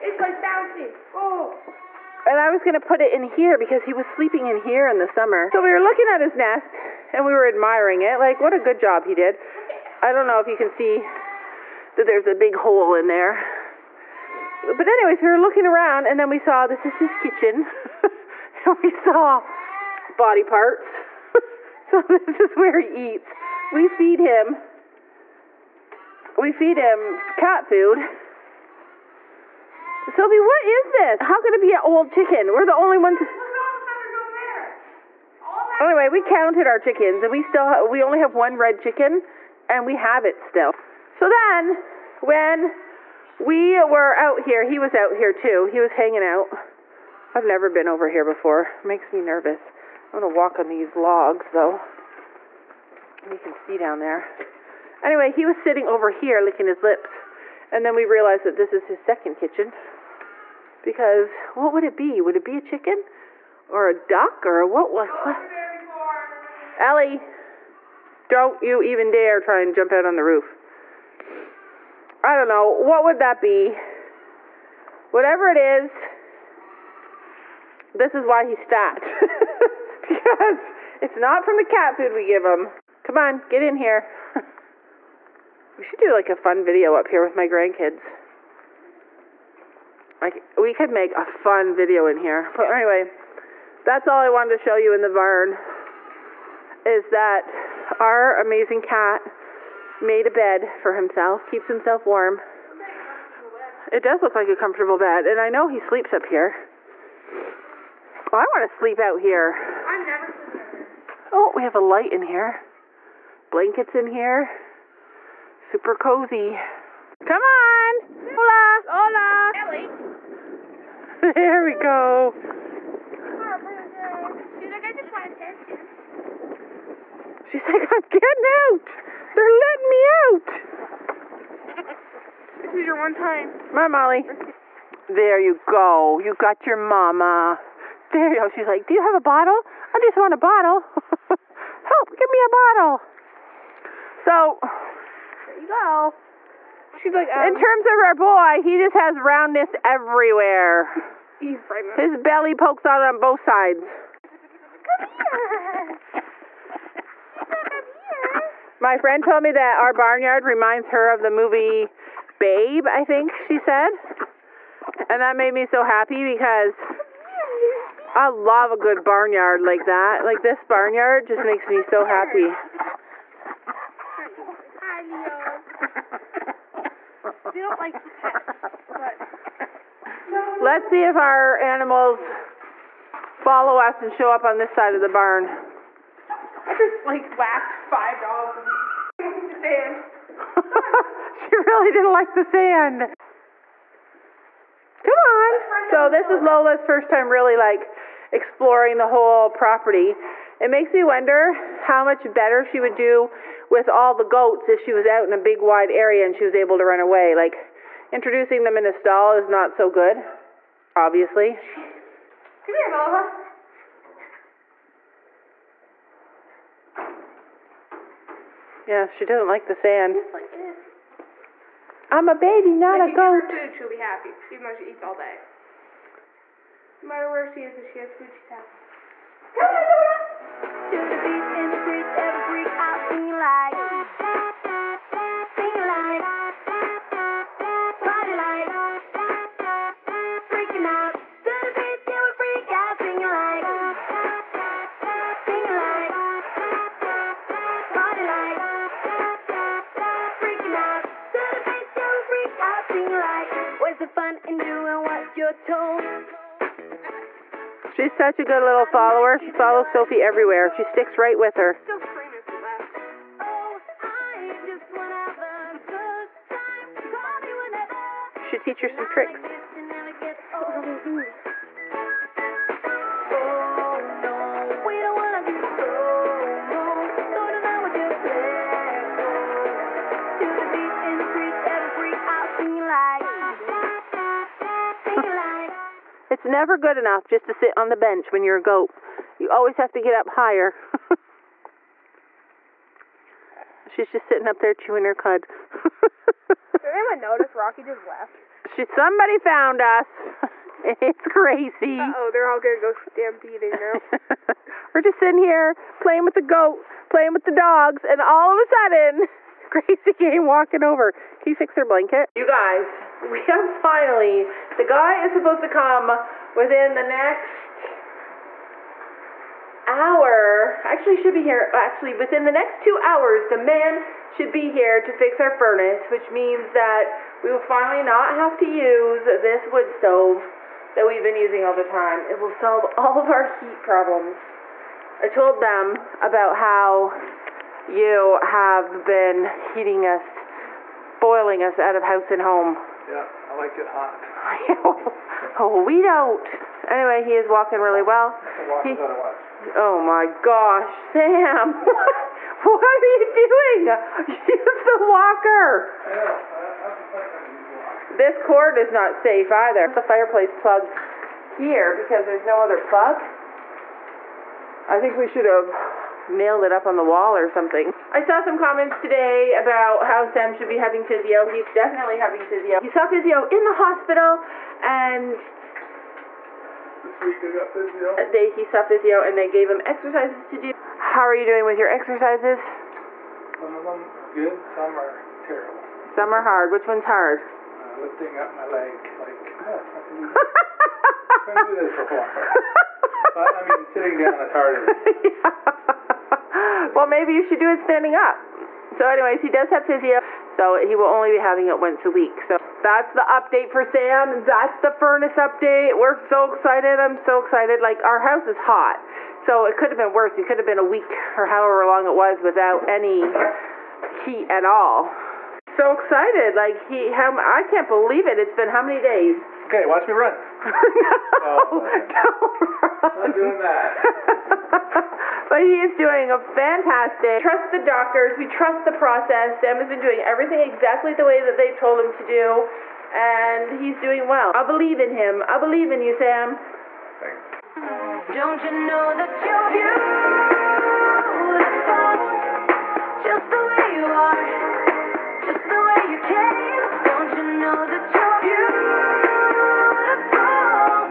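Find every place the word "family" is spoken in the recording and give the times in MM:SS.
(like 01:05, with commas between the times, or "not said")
not said.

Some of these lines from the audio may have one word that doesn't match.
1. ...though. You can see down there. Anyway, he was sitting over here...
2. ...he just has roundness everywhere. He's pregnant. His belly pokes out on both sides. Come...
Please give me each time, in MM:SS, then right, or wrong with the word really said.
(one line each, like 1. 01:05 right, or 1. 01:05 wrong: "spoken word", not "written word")
1. 00:51 right
2. 02:28 right.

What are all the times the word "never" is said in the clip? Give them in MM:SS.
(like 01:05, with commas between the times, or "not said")
00:47, 01:50, 04:46.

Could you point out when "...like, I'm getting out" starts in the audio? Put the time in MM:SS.
02:07.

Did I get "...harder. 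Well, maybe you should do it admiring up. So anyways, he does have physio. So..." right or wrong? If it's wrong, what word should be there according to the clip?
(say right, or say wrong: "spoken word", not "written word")
wrong: "standing", not "admiring".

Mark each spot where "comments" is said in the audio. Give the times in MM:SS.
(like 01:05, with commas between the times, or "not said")
06:08.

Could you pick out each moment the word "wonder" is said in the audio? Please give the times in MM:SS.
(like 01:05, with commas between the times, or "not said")
03:21.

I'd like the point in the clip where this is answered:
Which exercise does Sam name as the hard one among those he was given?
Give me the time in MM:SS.
06:28.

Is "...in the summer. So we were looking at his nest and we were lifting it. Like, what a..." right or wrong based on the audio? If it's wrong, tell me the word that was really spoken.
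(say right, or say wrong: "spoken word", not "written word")
wrong: "admiring", not "lifting".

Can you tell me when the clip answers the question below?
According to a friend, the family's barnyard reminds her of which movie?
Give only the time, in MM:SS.
02:42.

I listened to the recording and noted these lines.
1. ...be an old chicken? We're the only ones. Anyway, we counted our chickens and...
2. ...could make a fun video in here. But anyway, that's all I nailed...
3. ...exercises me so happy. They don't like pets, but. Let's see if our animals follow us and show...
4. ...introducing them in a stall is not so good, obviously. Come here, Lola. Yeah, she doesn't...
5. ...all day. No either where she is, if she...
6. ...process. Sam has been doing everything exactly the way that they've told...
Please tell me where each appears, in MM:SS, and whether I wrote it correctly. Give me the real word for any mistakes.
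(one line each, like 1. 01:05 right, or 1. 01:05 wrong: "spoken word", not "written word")
1. 00:31 right
2. 01:30 wrong: "wanted", not "nailed"
3. 02:51 wrong: "makes", not "exercises"
4. 03:28 right
5. 03:45 wrong: "matter", not "either"
6. 07:08 right.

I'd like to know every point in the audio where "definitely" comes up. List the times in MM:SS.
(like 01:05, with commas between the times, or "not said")
06:11.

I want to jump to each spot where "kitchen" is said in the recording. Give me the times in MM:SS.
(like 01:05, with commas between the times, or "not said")
00:17, 00:59.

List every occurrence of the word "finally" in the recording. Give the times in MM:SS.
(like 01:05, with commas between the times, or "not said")
05:13, 05:27.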